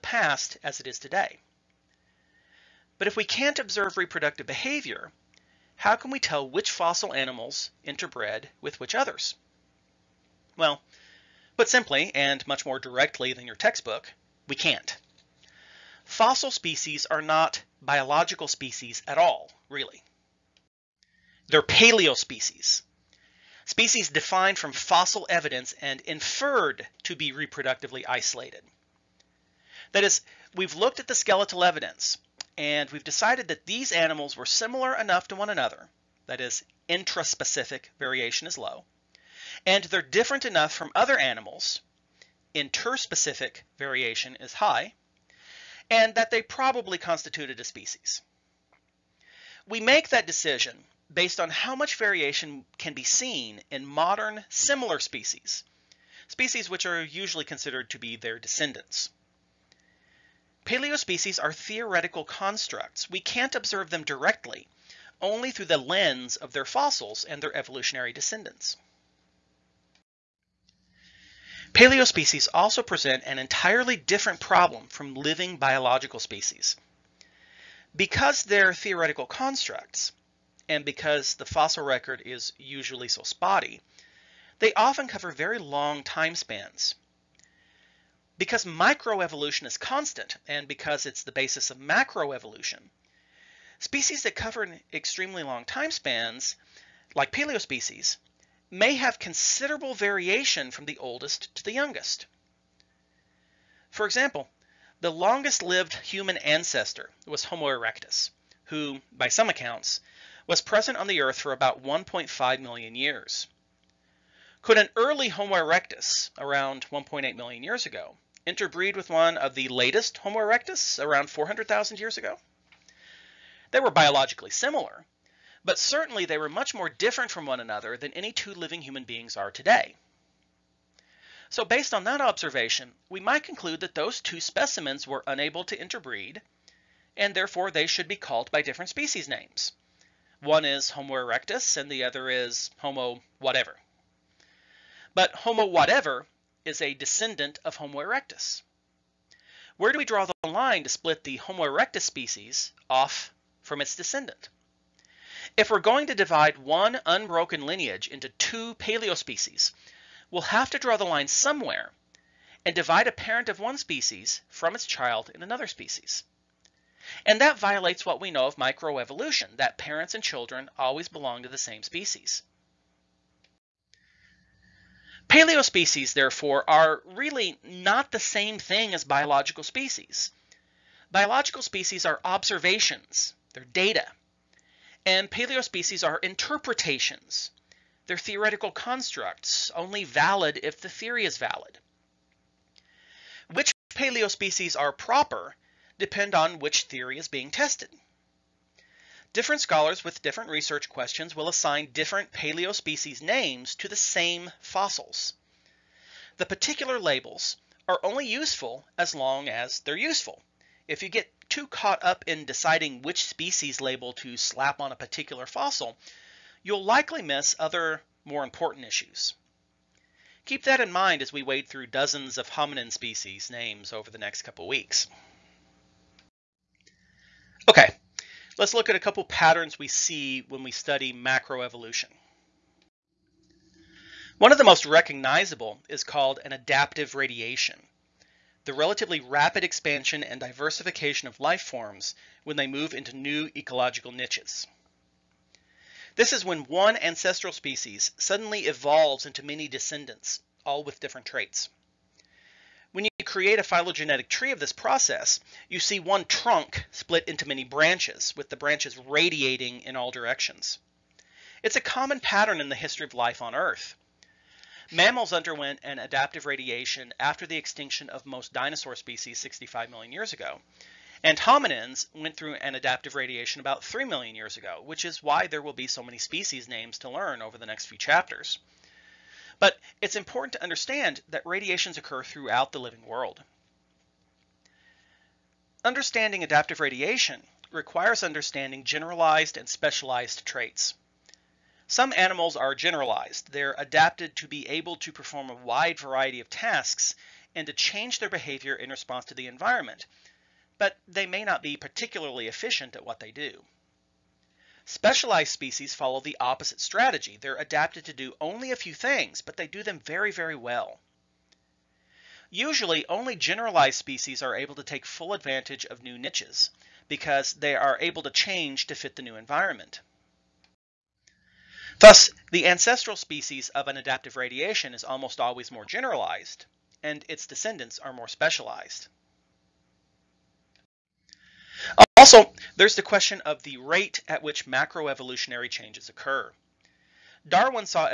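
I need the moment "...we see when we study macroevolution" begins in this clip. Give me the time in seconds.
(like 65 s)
229 s.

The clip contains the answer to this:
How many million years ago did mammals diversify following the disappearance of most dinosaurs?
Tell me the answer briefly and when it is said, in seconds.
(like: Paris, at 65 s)
65, at 269 s.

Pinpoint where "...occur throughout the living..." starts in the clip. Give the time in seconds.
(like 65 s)
281 s.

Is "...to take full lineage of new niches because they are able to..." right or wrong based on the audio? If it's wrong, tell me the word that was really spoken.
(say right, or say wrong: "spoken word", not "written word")
wrong: "advantage", not "lineage".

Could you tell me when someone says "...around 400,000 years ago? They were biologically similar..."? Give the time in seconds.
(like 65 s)
121 s.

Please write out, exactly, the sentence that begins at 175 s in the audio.
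Paleospecies, therefore, are really not the same thing as biological species.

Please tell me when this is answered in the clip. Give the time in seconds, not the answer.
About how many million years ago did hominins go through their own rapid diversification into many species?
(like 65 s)
273 s.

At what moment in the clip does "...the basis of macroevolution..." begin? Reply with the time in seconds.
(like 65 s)
91 s.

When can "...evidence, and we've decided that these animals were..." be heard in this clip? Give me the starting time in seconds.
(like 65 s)
31 s.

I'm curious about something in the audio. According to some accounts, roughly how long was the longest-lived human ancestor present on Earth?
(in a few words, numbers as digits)
1.5 million years.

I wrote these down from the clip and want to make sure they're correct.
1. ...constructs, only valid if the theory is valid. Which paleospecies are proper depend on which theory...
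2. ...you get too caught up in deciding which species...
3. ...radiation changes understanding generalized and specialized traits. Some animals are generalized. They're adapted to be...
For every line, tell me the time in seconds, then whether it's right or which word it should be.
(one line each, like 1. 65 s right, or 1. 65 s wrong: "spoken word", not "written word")
1. 188 s right
2. 211 s right
3. 286 s wrong: "requires", not "changes".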